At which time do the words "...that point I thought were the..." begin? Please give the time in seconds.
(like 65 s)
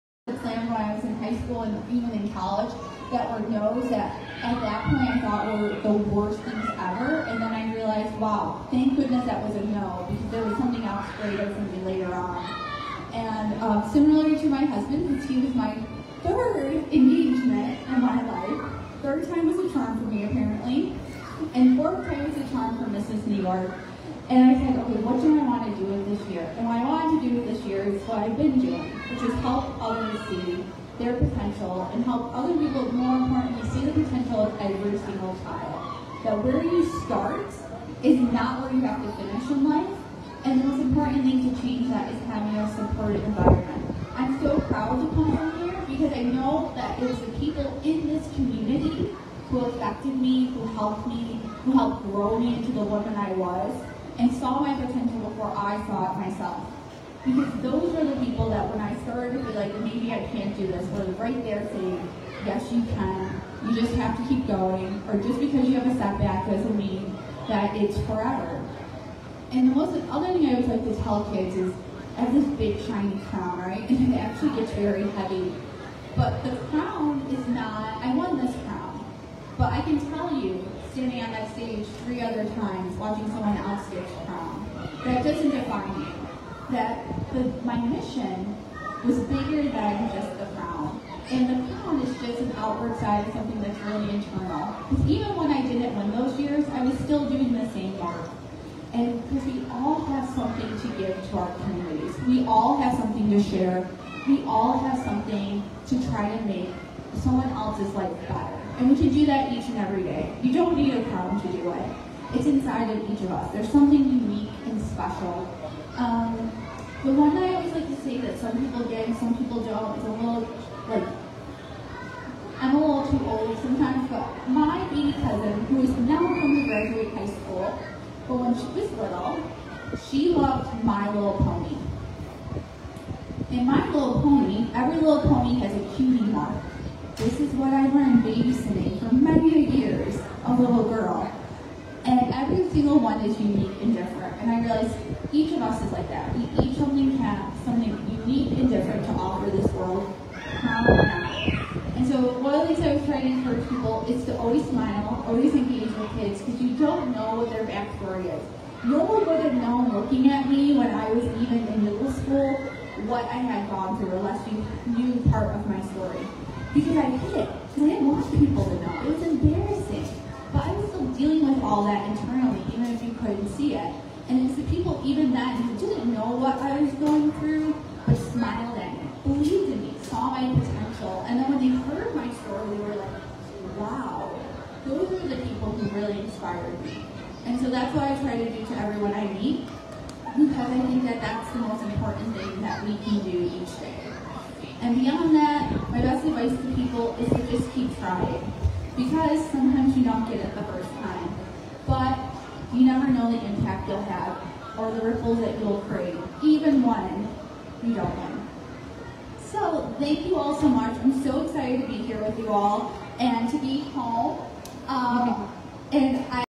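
4 s.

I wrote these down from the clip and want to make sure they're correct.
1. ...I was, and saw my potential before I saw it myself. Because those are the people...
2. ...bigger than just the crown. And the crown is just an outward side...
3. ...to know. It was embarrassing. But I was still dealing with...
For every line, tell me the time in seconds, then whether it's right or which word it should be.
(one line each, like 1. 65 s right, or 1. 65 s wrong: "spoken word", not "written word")
1. 53 s right
2. 89 s right
3. 168 s right.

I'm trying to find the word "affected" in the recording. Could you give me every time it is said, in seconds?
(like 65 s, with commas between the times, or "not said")
49 s.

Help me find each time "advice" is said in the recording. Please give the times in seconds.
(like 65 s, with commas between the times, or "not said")
196 s.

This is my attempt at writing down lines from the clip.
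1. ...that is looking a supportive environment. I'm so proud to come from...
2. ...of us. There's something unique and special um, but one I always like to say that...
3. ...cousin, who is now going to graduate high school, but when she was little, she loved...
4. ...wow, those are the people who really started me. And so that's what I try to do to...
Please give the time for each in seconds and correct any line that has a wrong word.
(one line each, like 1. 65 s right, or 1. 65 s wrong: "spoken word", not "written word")
1. 41 s wrong: "having", not "looking"
2. 113 s right
3. 125 s right
4. 183 s wrong: "inspired", not "started".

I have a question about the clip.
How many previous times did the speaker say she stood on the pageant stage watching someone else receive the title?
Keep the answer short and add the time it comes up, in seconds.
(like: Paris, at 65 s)
3, at 82 s.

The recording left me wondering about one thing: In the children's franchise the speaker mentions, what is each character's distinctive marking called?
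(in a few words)
cutie mark.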